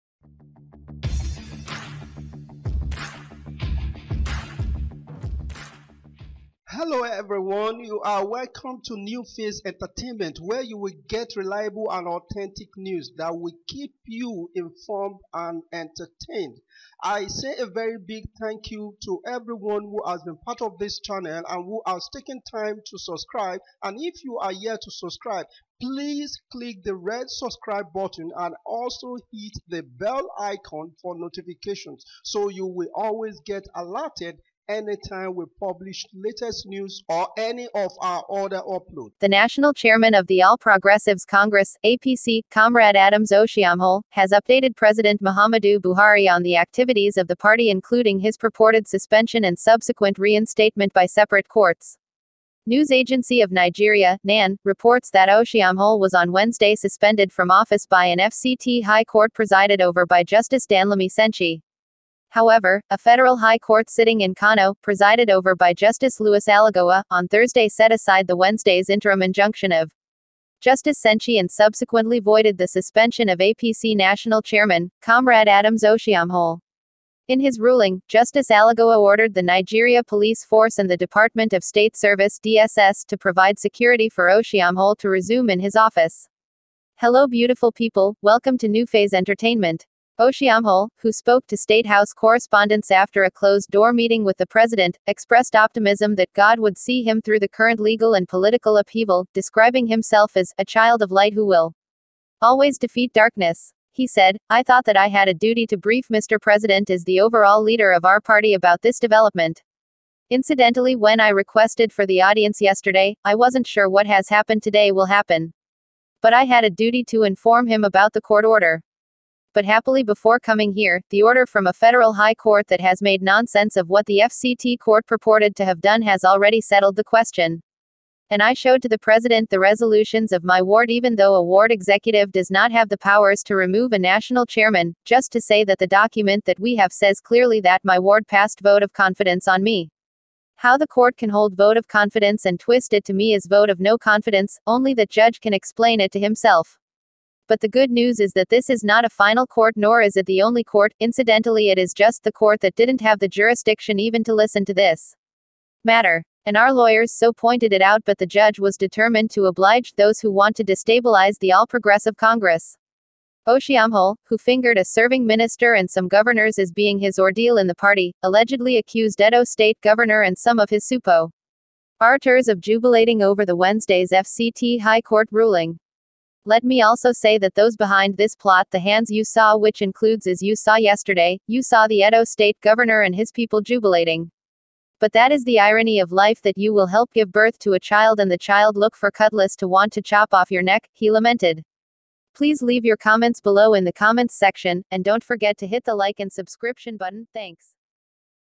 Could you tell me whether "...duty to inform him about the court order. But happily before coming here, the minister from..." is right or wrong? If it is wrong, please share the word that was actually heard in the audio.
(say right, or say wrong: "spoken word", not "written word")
wrong: "order", not "minister".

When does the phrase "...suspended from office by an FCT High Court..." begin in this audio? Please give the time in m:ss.
0:56.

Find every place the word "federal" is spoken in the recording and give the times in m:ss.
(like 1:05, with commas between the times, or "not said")
1:02, 2:01.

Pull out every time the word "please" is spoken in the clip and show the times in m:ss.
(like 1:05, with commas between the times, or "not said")
0:25, 3:12.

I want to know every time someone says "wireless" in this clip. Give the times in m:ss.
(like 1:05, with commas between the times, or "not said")
not said.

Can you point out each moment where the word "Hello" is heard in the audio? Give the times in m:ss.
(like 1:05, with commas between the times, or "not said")
0:06, 1:26.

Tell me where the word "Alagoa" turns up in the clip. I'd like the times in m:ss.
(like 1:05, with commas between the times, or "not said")
1:06, 1:18.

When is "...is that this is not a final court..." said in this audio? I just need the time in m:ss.
2:28.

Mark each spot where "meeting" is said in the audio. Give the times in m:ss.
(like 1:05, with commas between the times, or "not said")
1:33.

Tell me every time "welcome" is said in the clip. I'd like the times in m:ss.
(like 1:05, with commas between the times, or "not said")
0:08, 1:28.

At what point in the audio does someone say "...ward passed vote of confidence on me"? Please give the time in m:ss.
2:17.